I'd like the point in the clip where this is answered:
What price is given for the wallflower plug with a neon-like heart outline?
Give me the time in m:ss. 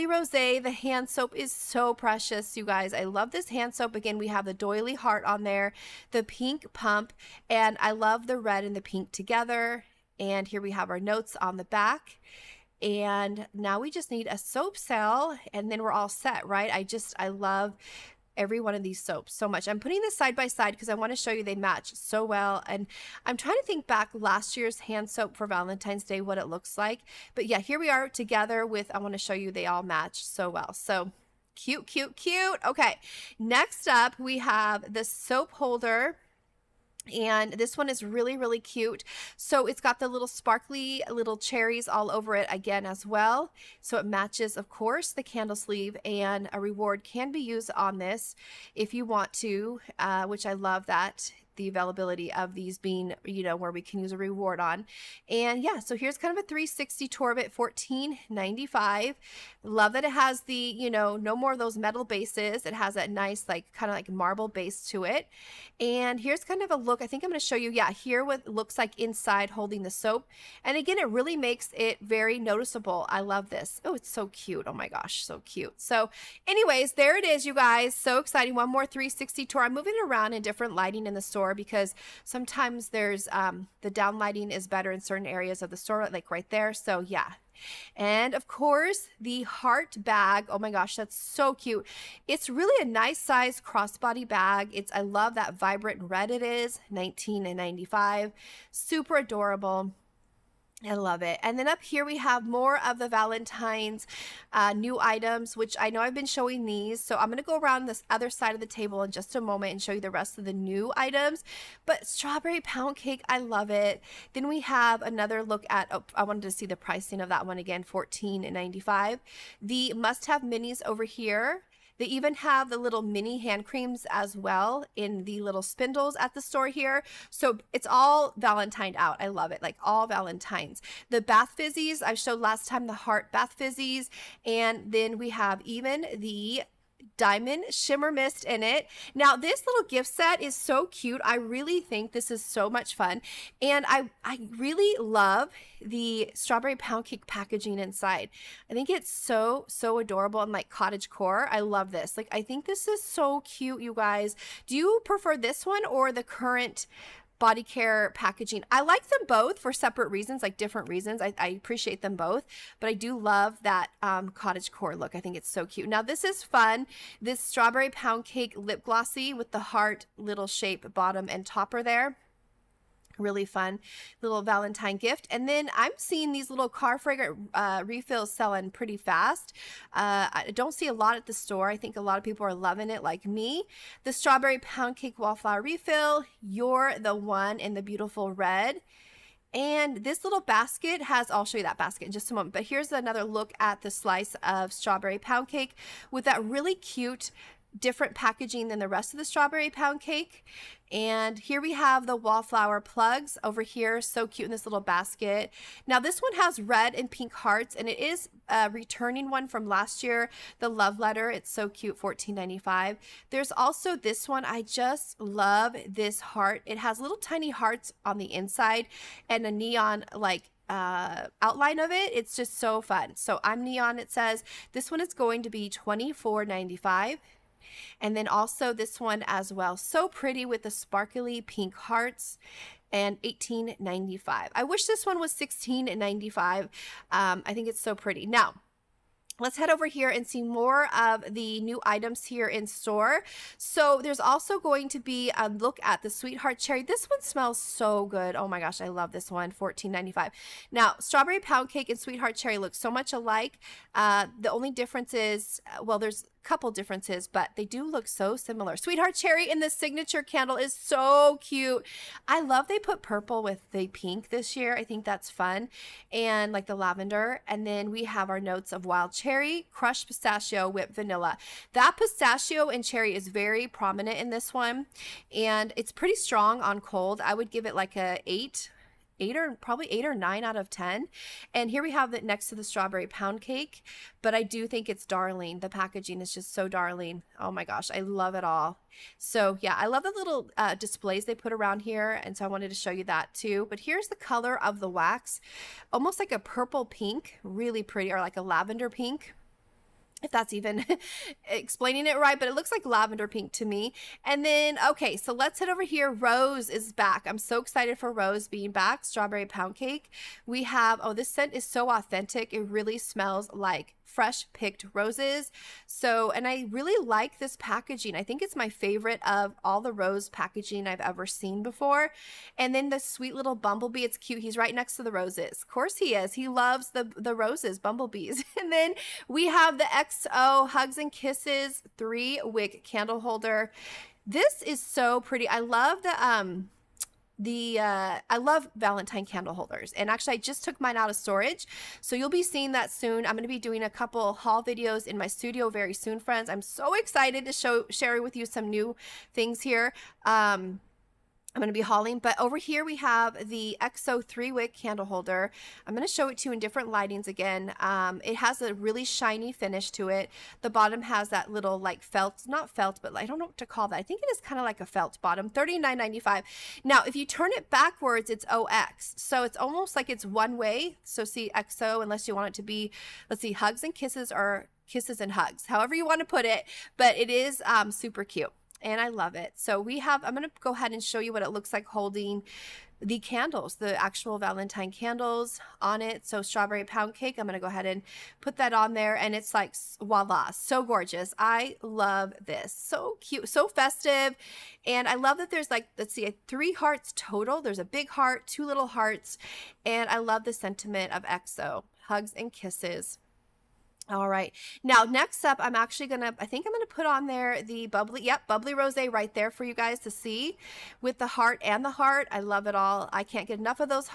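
3:45.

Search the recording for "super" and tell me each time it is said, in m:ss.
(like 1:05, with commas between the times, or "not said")
1:38, 6:17.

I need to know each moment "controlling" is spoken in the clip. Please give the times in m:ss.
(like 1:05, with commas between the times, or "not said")
not said.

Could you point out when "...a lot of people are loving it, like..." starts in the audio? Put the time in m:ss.
3:01.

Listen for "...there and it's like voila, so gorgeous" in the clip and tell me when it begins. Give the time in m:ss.
6:28.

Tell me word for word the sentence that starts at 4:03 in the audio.
So there's also going to be a look at the Sweetheart Cherry.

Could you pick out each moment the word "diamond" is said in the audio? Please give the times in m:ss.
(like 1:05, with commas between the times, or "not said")
2:17.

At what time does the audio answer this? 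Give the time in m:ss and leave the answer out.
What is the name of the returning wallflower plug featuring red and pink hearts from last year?
3:30.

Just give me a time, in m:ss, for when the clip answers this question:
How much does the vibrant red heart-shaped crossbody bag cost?
1:36.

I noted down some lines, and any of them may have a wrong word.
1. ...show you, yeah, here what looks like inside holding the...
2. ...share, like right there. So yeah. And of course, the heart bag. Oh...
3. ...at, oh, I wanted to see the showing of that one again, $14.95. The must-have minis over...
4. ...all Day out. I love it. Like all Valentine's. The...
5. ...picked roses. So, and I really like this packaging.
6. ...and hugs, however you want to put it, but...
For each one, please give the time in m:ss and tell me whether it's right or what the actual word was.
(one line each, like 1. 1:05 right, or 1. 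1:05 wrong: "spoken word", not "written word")
1. 1:07 right
2. 1:25 wrong: "store", not "share"
3. 1:55 wrong: "pricing", not "showing"
4. 2:07 wrong: "Valentine", not "Day"
5. 5:14 right
6. 6:15 right.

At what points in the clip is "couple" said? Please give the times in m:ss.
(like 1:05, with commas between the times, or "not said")
4:16, 5:43.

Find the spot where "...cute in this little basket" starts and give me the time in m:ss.
3:24.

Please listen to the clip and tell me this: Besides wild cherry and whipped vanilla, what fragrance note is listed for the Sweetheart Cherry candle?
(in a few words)
crushed pistachio.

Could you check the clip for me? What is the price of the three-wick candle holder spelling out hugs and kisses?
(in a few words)
$39.95.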